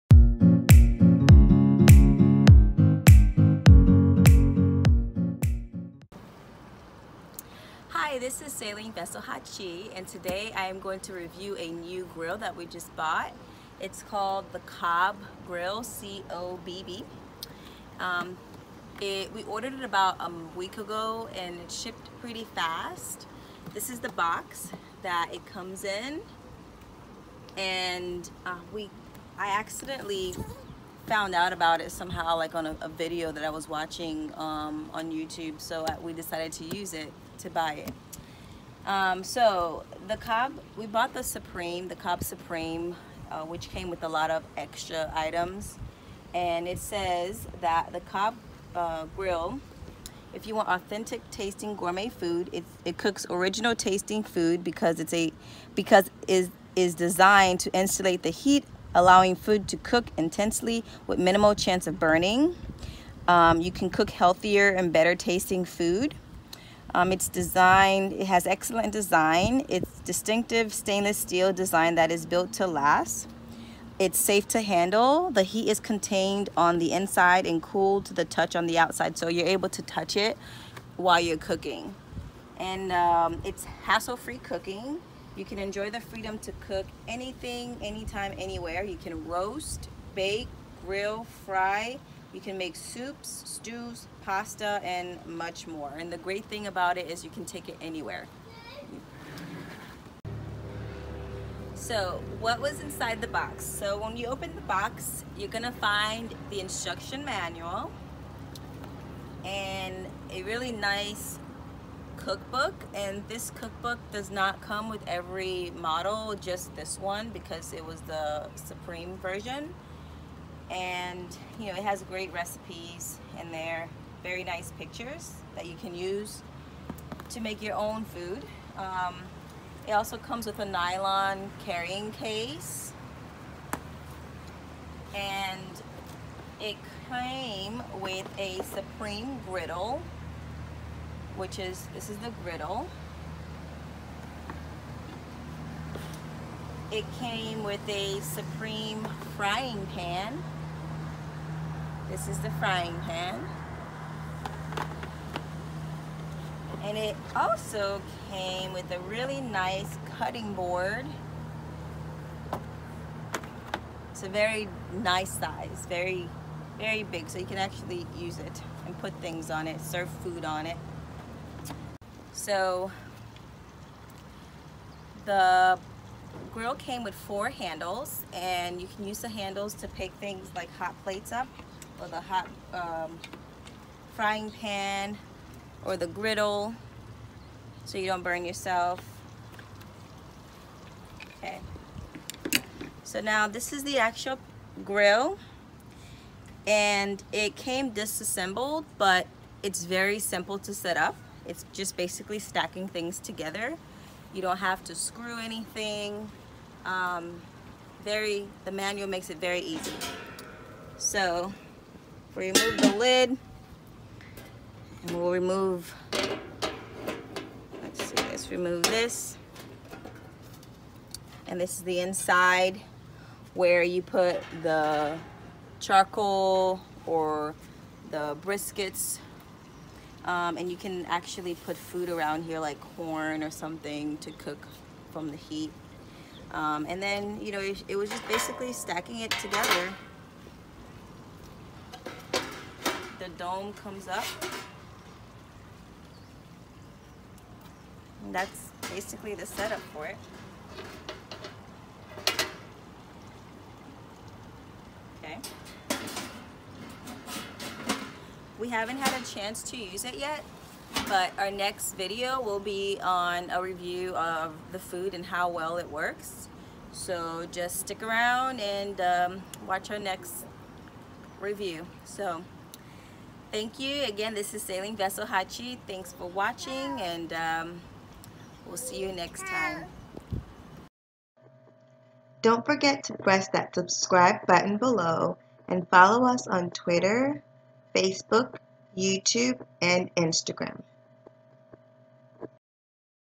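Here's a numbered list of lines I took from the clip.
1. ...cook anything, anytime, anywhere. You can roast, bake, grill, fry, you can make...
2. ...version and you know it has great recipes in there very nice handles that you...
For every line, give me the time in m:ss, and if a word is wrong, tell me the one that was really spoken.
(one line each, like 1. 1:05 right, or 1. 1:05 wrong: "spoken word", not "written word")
1. 1:26 right
2. 1:59 wrong: "pictures", not "handles".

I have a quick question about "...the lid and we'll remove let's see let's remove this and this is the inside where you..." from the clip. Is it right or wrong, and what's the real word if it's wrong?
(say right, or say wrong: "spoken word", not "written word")
right.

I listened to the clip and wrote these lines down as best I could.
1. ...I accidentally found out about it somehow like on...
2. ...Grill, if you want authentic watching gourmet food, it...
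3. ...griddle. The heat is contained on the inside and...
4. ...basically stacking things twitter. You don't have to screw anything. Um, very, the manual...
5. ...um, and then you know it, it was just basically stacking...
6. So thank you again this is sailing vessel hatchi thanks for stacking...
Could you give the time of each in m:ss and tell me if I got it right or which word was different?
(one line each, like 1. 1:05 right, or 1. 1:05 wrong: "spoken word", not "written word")
1. 0:29 right
2. 0:49 wrong: "tasting", not "watching"
3. 1:14 wrong: "handle", not "griddle"
4. 3:21 wrong: "together", not "twitter"
5. 3:56 right
6. 4:32 wrong: "watching", not "stacking".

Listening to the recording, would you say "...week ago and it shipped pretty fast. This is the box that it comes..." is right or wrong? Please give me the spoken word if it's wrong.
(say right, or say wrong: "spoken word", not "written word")
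right.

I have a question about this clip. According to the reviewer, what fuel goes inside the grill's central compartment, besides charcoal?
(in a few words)
briquettes.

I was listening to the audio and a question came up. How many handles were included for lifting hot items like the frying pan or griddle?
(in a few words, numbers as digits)
4.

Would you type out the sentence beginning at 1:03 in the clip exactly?
Um, you can cook healthier and better tasting food.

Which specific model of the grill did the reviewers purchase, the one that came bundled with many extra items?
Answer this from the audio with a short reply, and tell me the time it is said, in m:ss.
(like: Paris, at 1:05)
Cobb Supreme, at 0:41.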